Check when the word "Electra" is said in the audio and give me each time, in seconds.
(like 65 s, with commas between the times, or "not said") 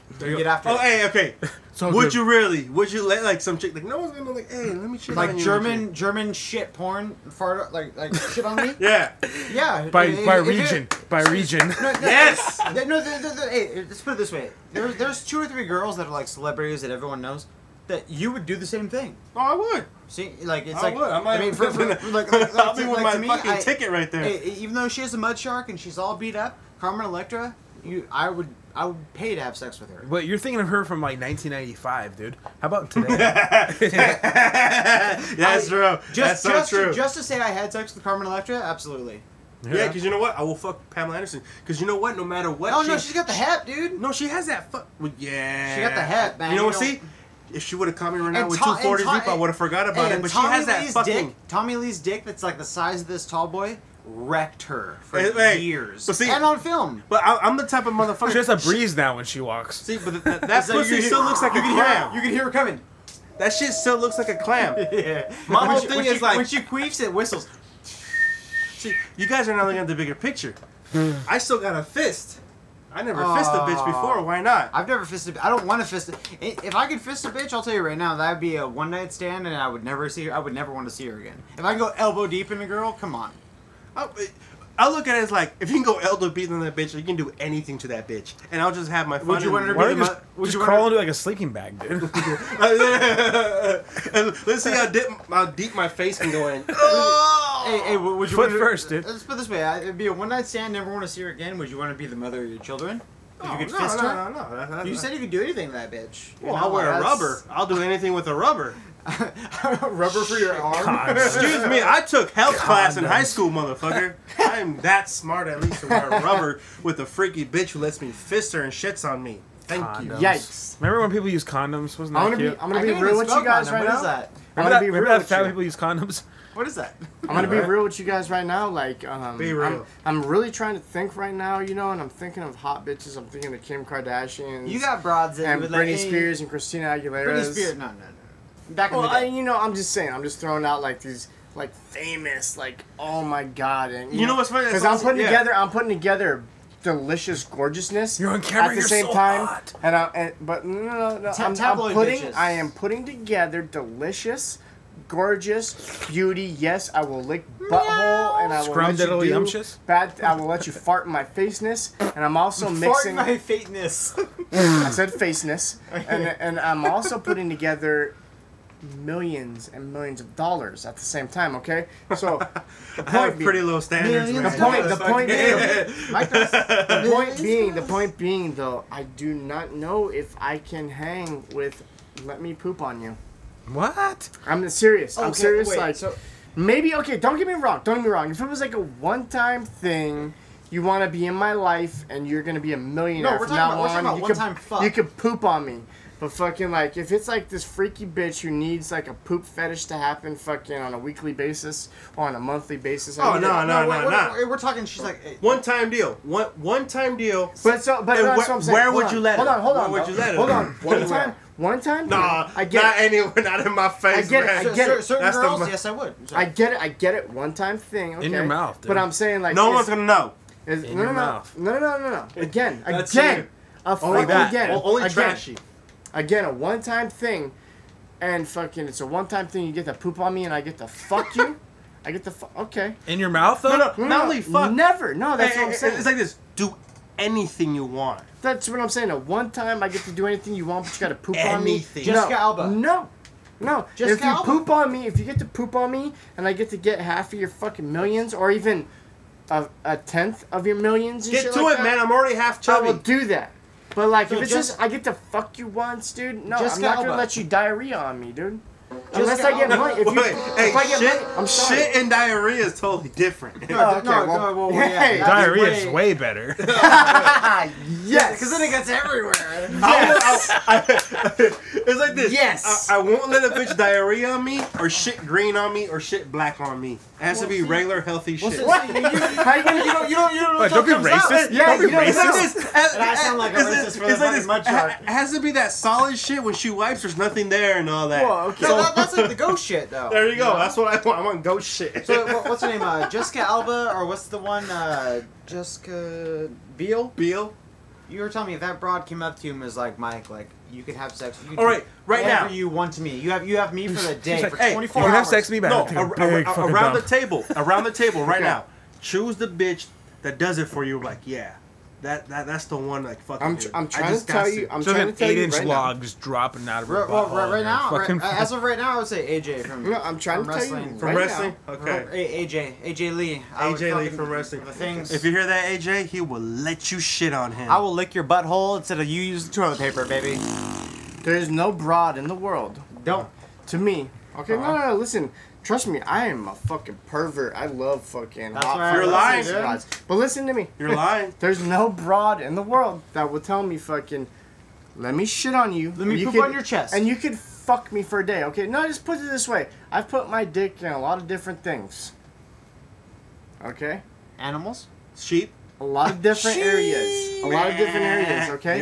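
27 s, 38 s.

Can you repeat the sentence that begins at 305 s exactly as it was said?
No, ar- ar- ar- around dump.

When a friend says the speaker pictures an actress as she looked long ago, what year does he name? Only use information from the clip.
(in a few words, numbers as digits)
1995.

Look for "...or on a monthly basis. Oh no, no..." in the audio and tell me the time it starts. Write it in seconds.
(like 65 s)
202 s.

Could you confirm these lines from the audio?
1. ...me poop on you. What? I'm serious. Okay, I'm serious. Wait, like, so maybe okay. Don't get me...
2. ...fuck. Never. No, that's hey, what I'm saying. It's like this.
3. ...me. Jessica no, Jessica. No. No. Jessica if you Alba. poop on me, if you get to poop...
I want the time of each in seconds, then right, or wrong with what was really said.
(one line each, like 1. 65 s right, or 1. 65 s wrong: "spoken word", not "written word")
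1. 182 s right
2. 234 s right
3. 241 s wrong: "Alba", not "Jessica".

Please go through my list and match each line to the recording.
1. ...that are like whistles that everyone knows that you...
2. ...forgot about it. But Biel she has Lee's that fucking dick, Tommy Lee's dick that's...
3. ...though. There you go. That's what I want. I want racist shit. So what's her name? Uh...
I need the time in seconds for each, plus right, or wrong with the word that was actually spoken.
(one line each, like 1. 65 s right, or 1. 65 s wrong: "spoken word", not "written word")
1. 15 s wrong: "celebrities", not "whistles"
2. 49 s wrong: "Tommy", not "Biel"
3. 289 s wrong: "ghost", not "racist".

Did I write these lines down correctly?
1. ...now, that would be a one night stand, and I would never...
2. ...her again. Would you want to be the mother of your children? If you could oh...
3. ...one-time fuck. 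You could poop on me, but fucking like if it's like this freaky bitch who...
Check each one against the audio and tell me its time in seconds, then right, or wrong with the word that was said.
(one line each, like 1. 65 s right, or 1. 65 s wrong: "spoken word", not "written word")
1. 77 s right
2. 101 s right
3. 194 s right.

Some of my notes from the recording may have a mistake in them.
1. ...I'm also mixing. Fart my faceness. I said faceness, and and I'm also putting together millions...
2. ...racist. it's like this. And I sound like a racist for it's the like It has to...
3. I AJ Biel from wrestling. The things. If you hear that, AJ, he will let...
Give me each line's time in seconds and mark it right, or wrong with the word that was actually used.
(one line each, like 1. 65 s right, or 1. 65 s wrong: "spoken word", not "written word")
1. 162 s right
2. 281 s right
3. 323 s wrong: "Lee", not "Biel".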